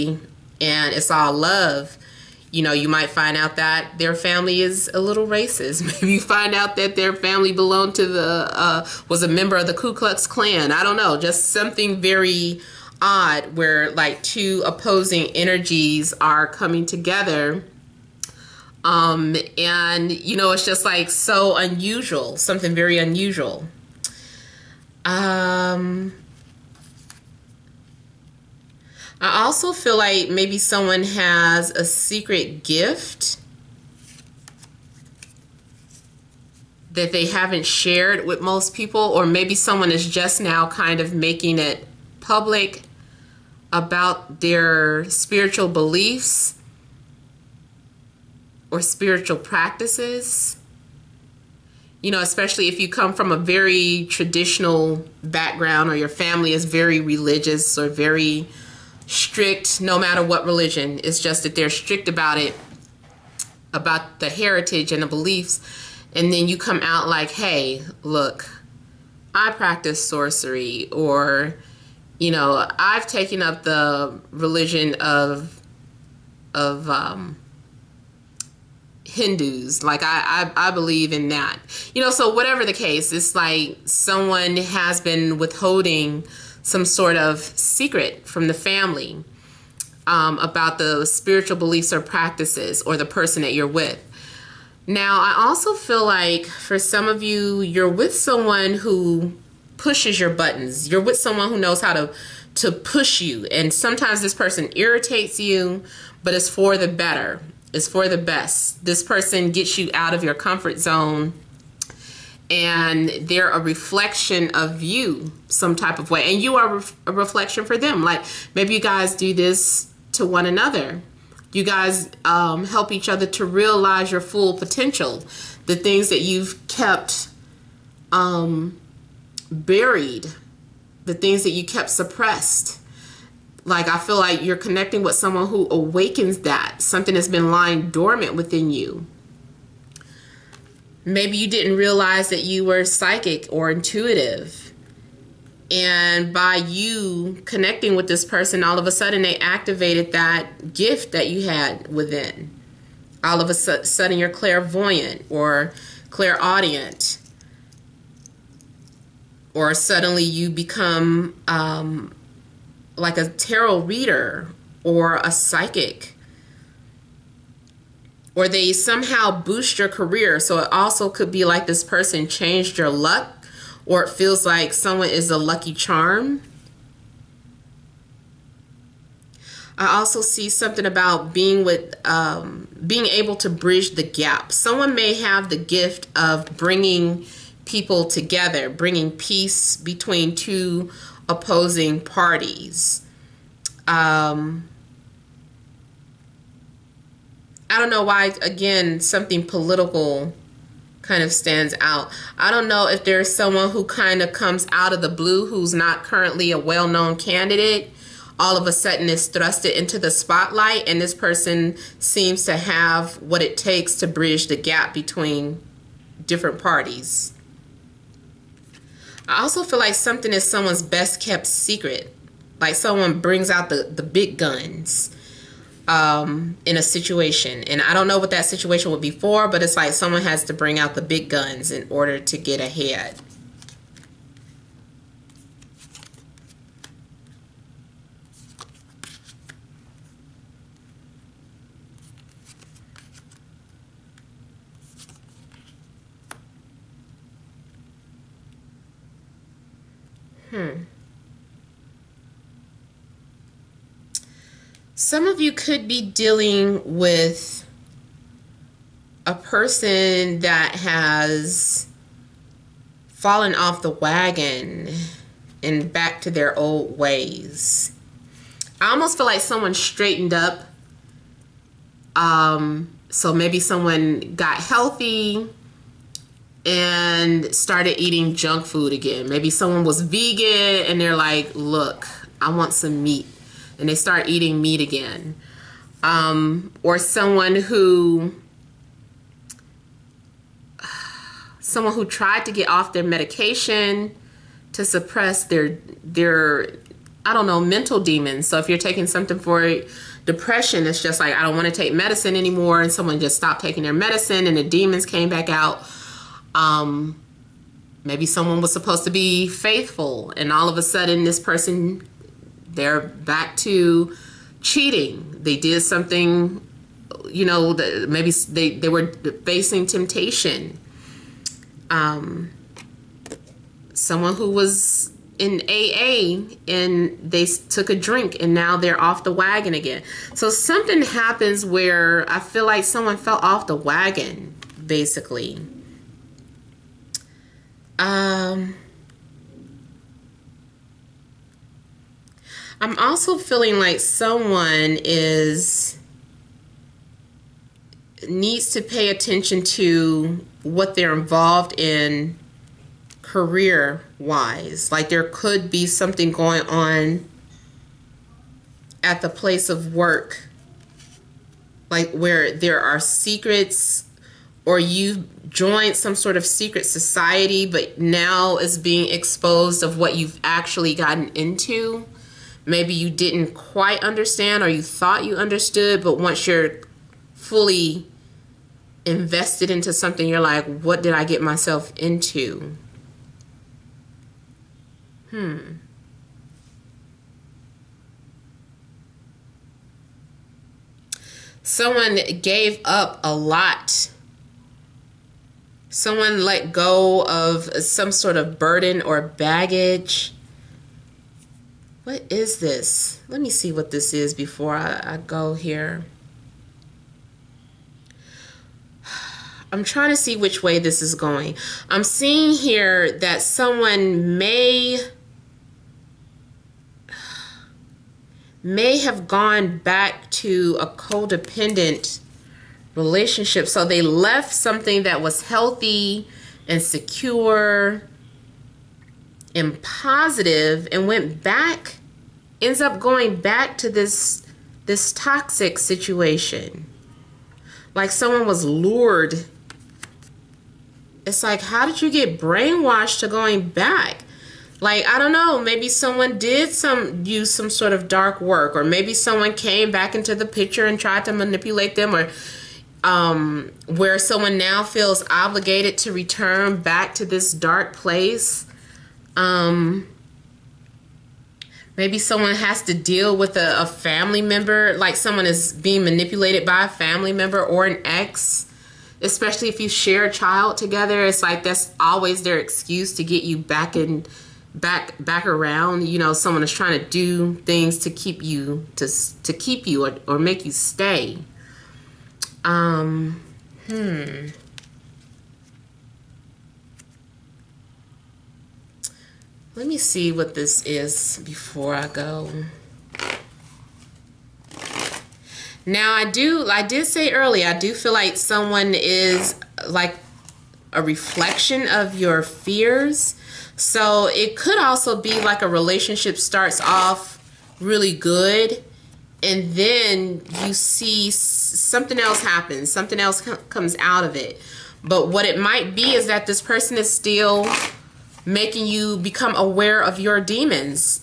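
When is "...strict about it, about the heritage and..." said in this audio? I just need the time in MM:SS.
01:01.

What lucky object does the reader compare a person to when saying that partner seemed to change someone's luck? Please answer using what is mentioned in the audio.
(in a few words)
lucky charm.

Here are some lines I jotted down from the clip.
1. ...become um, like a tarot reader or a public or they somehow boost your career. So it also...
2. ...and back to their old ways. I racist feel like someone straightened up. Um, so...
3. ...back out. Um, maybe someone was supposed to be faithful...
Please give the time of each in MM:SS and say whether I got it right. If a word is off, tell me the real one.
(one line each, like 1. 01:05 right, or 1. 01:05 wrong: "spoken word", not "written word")
1. 02:40 wrong: "psychic", not "public"
2. 04:25 wrong: "almost", not "racist"
3. 05:05 right.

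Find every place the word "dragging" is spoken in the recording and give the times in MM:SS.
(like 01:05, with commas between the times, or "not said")
not said.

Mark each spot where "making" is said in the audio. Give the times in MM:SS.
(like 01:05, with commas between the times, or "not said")
00:41, 08:38.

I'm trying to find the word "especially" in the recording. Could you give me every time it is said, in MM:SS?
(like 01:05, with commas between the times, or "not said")
00:52, 07:49.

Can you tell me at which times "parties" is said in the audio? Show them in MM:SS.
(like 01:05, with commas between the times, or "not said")
03:11, 03:36.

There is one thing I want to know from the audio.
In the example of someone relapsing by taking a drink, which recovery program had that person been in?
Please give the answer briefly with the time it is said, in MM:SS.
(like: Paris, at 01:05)
AA, at 05:25.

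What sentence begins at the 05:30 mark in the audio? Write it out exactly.
So something happens where I feel like someone fell off the wagon, basically.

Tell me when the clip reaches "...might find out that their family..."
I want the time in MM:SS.
00:02.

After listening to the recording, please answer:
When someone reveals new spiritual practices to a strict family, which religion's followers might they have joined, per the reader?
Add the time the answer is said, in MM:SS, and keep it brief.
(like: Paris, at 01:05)
Hindus, at 01:19.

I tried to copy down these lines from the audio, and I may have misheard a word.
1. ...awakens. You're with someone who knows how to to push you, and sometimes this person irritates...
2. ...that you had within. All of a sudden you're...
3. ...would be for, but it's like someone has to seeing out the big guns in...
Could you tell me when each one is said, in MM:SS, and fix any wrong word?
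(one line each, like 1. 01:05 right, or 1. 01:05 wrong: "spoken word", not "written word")
1. 01:40 wrong: "buttons", not "awakens"
2. 02:31 right
3. 03:48 wrong: "bring", not "seeing".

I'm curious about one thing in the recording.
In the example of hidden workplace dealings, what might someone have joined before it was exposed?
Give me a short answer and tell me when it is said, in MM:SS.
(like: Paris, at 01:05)
secret society, at 06:06.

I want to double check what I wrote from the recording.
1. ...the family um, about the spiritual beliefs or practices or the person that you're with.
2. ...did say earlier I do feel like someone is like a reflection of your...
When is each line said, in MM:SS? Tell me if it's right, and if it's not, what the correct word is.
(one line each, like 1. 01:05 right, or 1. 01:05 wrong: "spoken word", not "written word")
1. 01:28 right
2. 08:16 right.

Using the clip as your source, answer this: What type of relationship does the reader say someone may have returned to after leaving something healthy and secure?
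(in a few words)
codependent relationship.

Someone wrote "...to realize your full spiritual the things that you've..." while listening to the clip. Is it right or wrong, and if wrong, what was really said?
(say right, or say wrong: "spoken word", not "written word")
wrong: "potential", not "spiritual".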